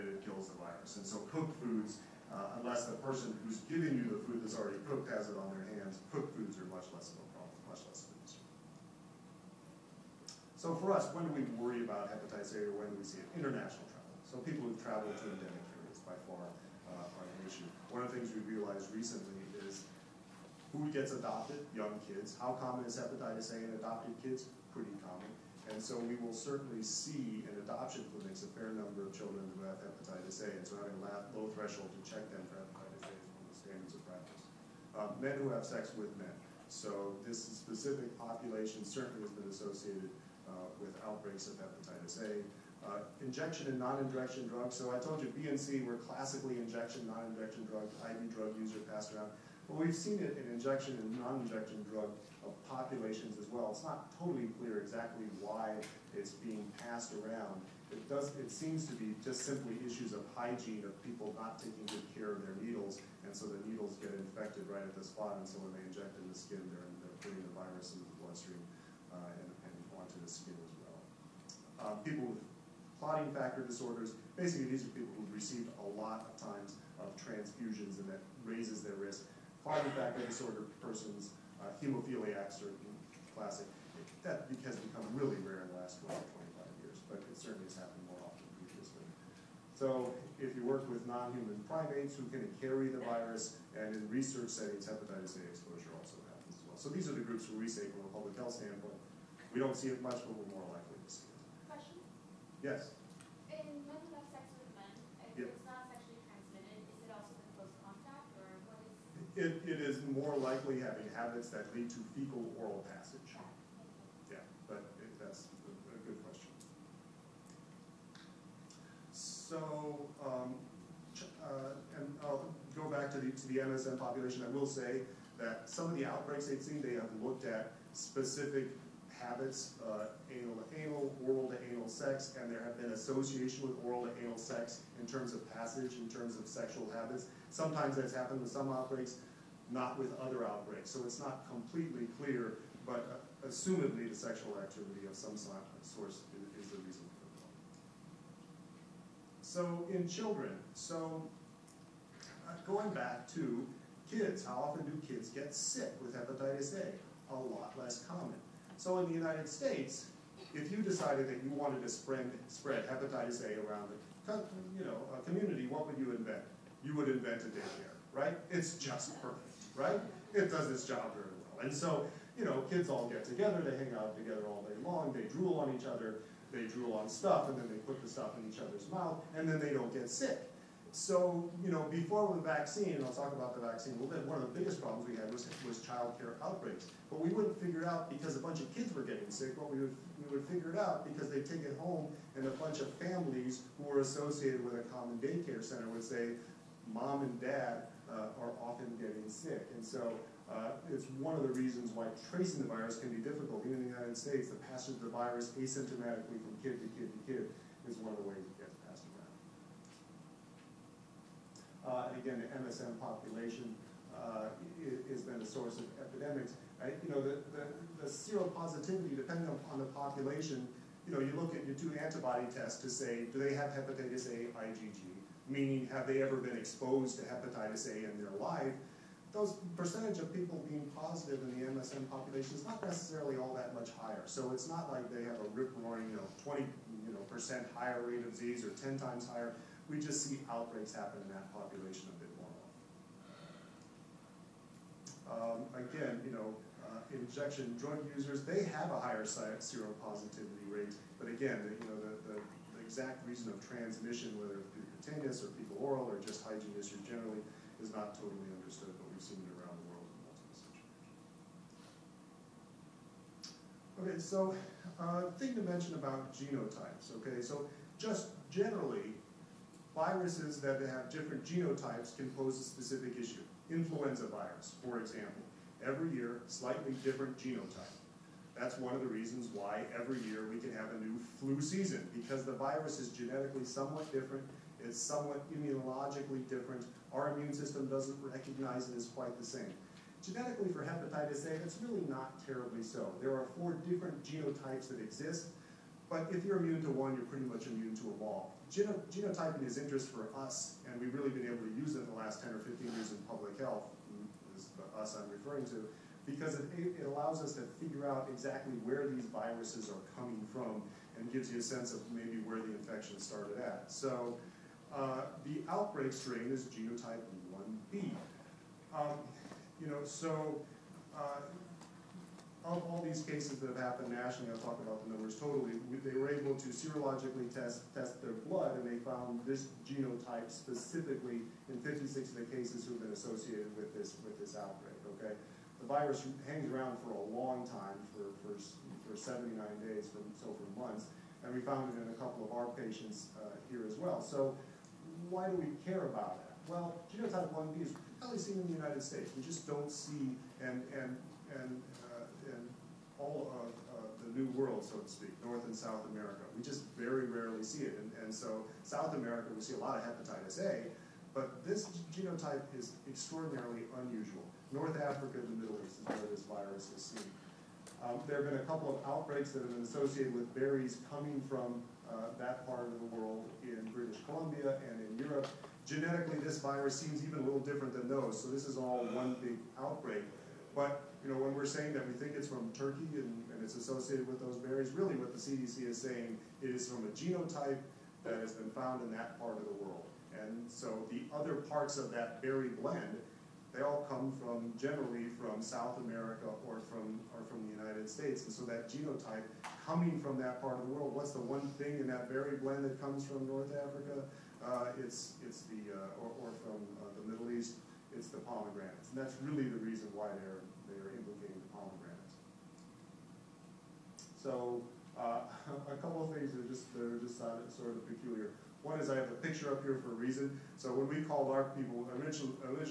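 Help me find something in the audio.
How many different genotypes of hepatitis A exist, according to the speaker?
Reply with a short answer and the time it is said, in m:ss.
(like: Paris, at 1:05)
4, at 4:53.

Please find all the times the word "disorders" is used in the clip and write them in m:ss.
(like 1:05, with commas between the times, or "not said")
1:13, 1:20.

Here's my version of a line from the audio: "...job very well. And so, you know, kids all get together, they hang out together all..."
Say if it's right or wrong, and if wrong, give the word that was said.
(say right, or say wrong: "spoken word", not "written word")
right.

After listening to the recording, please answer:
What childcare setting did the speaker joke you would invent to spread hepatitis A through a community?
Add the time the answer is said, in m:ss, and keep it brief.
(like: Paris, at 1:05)
A daycare, at 2:47.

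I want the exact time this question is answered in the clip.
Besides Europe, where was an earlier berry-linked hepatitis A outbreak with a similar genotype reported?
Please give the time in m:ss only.
6:13.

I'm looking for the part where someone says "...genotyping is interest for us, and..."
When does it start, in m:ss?
4:59.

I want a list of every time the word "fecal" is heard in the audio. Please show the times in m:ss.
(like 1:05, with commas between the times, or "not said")
1:52, 4:15.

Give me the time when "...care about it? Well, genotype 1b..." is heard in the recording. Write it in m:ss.
5:45.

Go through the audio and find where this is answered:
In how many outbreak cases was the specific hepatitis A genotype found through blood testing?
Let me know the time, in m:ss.
5:31.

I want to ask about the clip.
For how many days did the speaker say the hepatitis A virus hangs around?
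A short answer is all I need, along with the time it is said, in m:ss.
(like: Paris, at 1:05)
79, at 5:39.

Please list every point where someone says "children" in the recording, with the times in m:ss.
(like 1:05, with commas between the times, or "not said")
0:29, 2:30.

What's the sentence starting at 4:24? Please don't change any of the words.
Okay, so uh, thing to mention about genotypes, okay, so just generally, Viruses that have different genotypes can pose a specific issue.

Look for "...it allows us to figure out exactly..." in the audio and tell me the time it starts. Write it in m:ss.
5:06.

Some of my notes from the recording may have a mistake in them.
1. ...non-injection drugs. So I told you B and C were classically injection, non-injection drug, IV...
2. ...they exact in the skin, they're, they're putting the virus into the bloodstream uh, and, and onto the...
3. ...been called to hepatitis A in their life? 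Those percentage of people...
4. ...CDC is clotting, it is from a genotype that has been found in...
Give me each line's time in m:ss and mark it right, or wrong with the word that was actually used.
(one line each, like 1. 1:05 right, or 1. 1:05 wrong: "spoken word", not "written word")
1. 0:43 right
2. 1:05 wrong: "inject", not "exact"
3. 3:46 wrong: "exposed", not "called"
4. 6:25 wrong: "saying", not "clotting".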